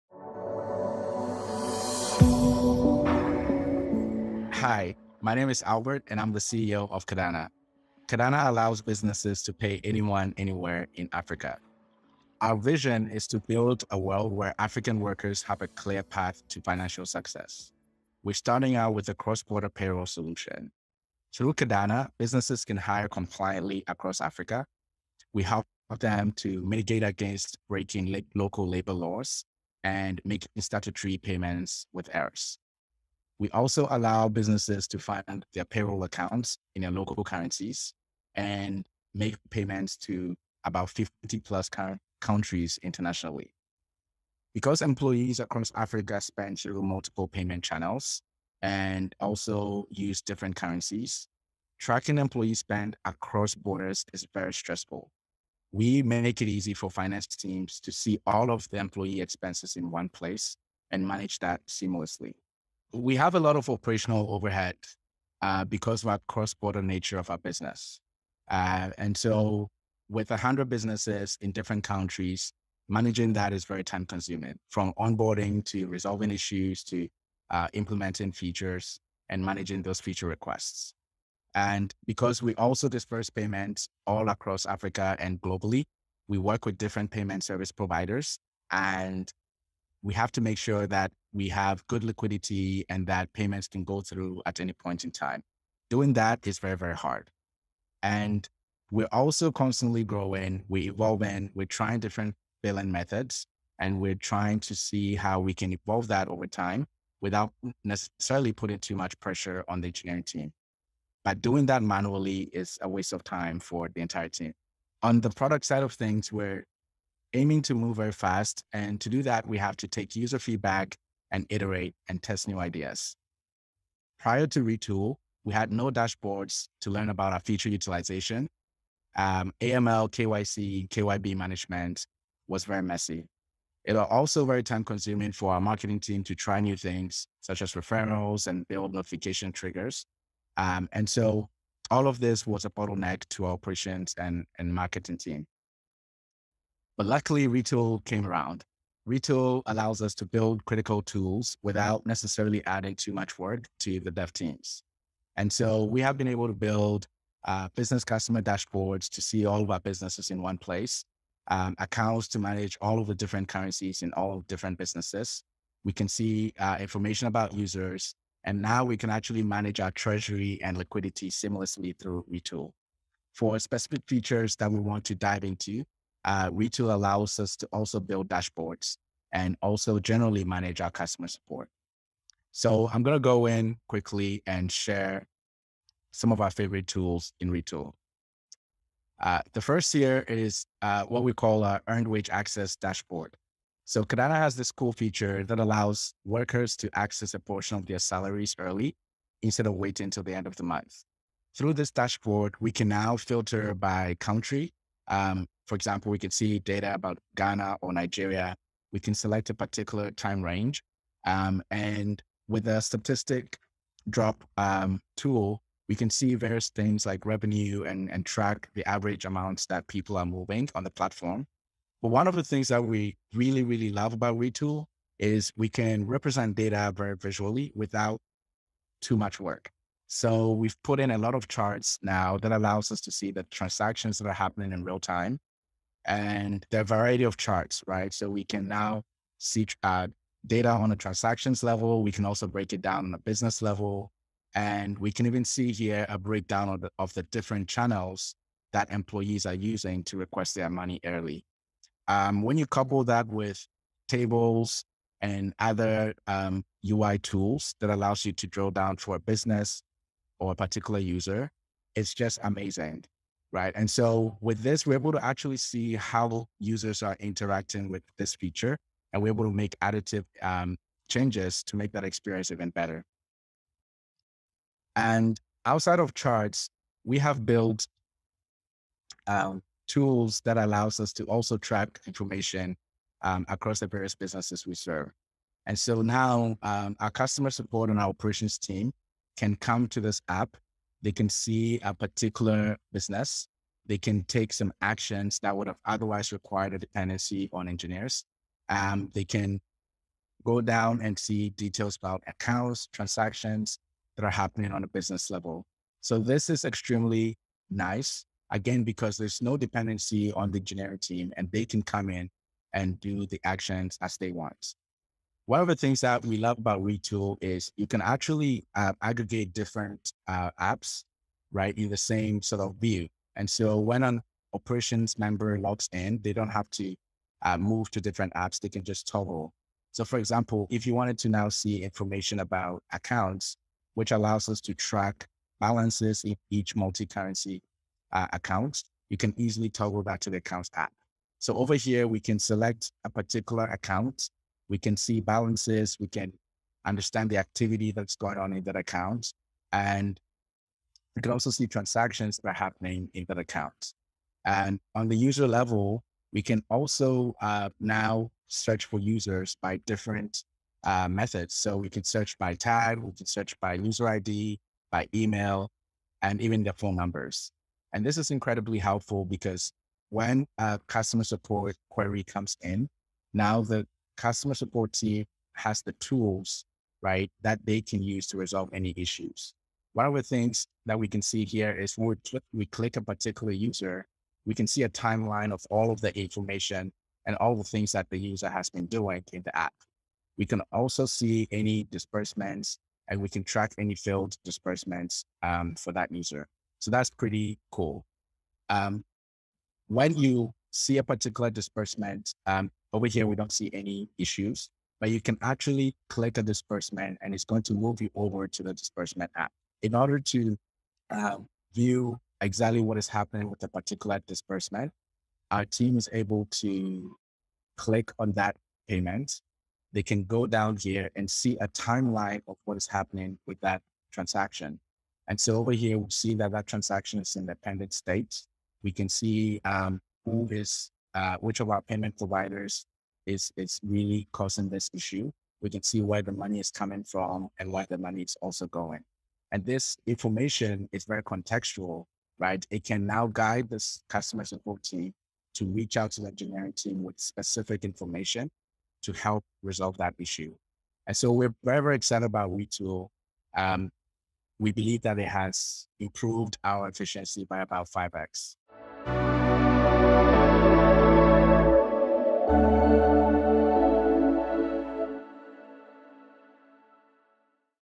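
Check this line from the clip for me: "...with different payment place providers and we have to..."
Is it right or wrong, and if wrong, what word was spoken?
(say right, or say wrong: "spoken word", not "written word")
wrong: "service", not "place".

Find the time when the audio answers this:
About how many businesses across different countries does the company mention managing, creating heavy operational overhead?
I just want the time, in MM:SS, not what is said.
01:10.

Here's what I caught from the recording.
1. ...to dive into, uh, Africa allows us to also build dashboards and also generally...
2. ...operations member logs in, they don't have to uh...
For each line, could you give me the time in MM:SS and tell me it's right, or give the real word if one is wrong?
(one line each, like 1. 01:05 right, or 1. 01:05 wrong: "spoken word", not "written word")
1. 02:55 wrong: "Retool", not "Africa"
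2. 05:24 right.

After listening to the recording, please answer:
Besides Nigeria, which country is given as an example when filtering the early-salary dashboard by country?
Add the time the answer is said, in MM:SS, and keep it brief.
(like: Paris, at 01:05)
Ghana, at 03:27.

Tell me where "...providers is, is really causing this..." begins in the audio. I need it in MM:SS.
07:12.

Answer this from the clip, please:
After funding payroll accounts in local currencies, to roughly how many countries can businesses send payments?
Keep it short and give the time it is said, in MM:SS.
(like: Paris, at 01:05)
50, at 00:40.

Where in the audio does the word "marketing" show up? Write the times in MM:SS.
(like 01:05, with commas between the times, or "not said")
02:15, 02:24.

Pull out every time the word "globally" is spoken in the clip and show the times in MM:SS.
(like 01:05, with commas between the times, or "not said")
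01:25.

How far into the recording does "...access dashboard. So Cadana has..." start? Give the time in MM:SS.
03:12.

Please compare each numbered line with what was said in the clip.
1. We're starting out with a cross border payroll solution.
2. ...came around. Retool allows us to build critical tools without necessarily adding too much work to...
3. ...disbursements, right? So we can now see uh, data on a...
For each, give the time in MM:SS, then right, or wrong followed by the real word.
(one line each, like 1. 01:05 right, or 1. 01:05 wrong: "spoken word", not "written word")
1. 00:18 right
2. 02:28 right
3. 03:57 wrong: "charts", not "disbursements".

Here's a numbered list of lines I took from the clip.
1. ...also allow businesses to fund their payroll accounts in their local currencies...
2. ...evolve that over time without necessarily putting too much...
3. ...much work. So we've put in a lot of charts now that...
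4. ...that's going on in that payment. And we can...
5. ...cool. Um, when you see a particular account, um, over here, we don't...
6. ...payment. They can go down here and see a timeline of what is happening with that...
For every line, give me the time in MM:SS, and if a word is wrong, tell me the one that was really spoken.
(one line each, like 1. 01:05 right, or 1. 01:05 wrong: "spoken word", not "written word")
1. 00:33 right
2. 01:45 right
3. 03:49 right
4. 05:47 wrong: "account", not "payment"
5. 06:37 wrong: "disbursement", not "account"
6. 06:58 right.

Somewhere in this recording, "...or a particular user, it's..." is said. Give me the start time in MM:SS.
04:20.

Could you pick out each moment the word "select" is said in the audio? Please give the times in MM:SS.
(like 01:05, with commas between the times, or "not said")
03:29, 05:42.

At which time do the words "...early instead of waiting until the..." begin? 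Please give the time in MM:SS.
03:18.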